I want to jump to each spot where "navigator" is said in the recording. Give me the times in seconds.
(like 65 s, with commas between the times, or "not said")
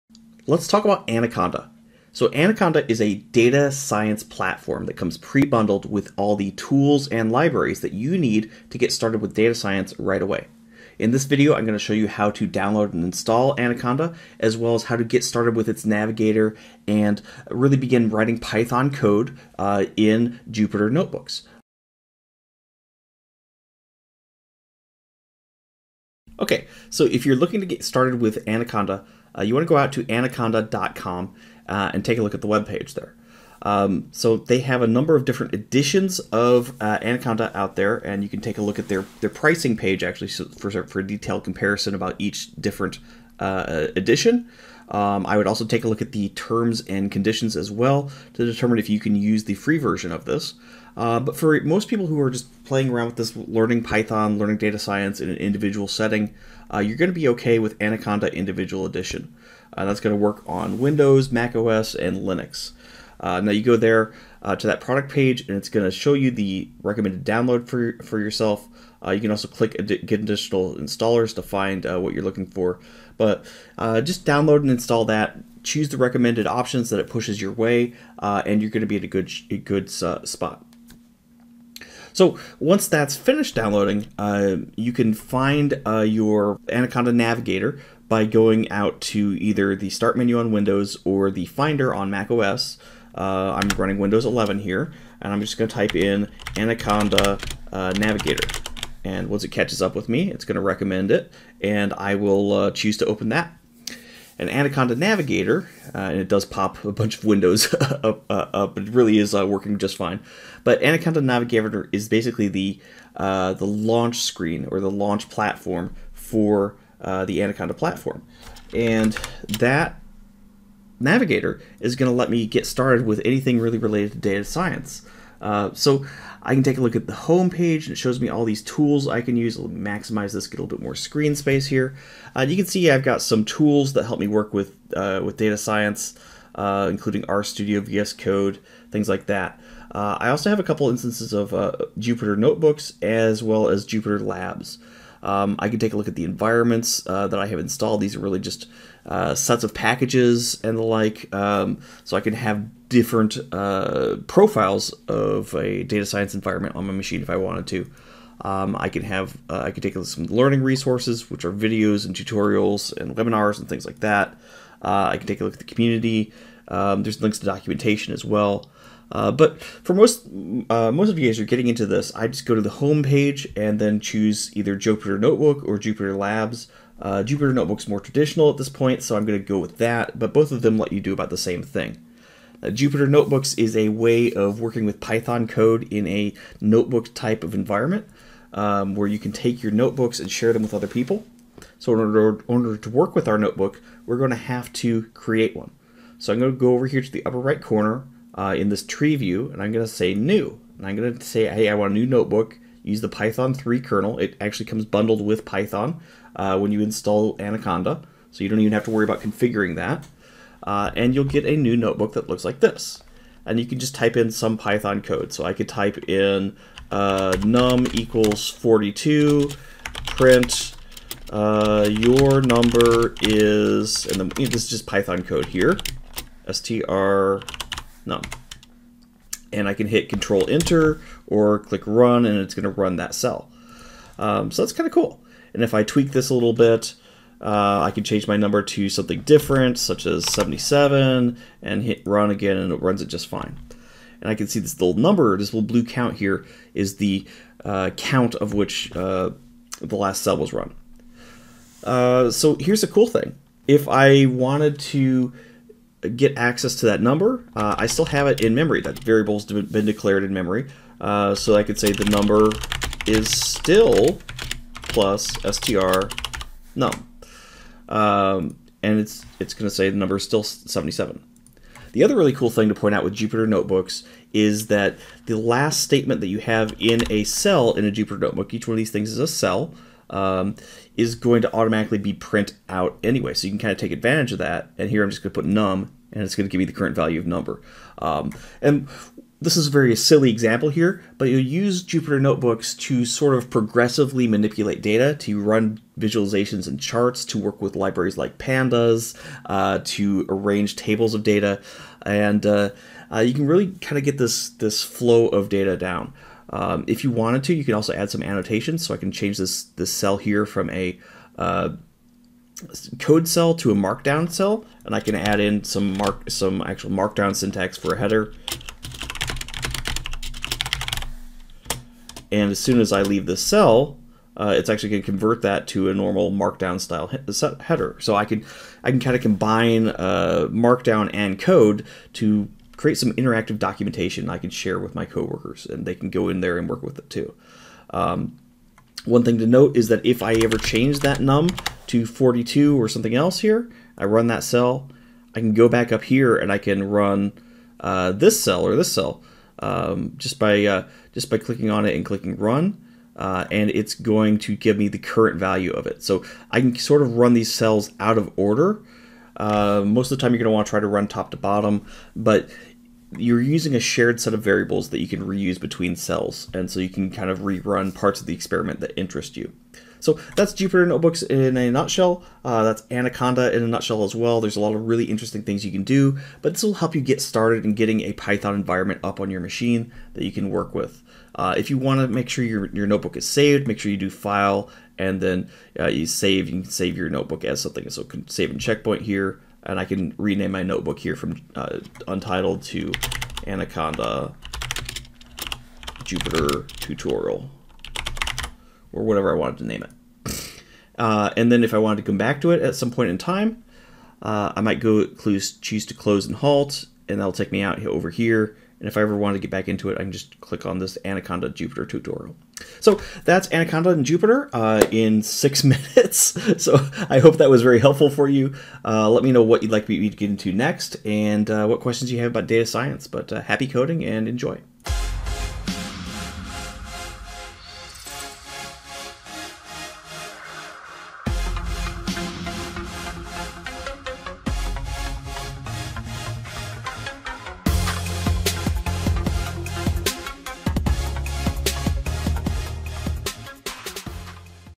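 15 s, 87 s, 97 s, 104 s, 111 s, 120 s.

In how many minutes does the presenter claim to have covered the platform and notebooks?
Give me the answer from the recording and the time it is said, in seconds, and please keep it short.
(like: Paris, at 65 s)
6, at 415 s.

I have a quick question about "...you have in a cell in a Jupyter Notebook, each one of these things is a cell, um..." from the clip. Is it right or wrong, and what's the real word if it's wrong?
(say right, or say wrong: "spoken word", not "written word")
right.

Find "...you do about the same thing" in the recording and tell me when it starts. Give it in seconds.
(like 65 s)
180 s.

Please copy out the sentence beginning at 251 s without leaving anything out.
Uh, so here's a cool thing.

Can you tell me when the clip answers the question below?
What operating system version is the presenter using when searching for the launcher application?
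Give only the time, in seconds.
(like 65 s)
93 s.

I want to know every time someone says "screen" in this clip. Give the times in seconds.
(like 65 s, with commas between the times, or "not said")
114 s, 130 s.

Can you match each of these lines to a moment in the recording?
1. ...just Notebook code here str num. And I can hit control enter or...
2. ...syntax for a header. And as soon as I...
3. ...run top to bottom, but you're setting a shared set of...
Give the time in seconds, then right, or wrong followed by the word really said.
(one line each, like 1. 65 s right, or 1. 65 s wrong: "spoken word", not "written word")
1. 224 s wrong: "Python", not "Notebook"
2. 317 s right
3. 360 s wrong: "using", not "setting".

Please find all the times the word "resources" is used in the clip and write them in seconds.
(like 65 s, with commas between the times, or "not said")
160 s.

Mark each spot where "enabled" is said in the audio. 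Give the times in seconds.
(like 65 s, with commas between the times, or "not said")
not said.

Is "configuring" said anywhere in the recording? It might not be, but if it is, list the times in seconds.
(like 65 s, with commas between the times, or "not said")
209 s.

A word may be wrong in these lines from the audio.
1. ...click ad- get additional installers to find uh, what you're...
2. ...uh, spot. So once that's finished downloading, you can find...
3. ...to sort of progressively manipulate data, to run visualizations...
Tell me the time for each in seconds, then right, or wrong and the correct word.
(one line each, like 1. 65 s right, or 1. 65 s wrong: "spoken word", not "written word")
1. 69 s right
2. 80 s right
3. 292 s right.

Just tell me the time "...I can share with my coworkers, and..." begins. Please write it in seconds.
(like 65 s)
334 s.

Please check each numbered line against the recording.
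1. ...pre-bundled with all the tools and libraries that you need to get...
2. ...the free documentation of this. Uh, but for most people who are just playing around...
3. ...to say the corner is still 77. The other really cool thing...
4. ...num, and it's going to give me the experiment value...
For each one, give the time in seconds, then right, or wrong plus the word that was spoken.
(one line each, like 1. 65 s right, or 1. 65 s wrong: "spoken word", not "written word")
1. 5 s right
2. 49 s wrong: "version", not "documentation"
3. 269 s wrong: "number", not "corner"
4. 285 s wrong: "current", not "experiment".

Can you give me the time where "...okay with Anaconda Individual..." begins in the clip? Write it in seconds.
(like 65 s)
57 s.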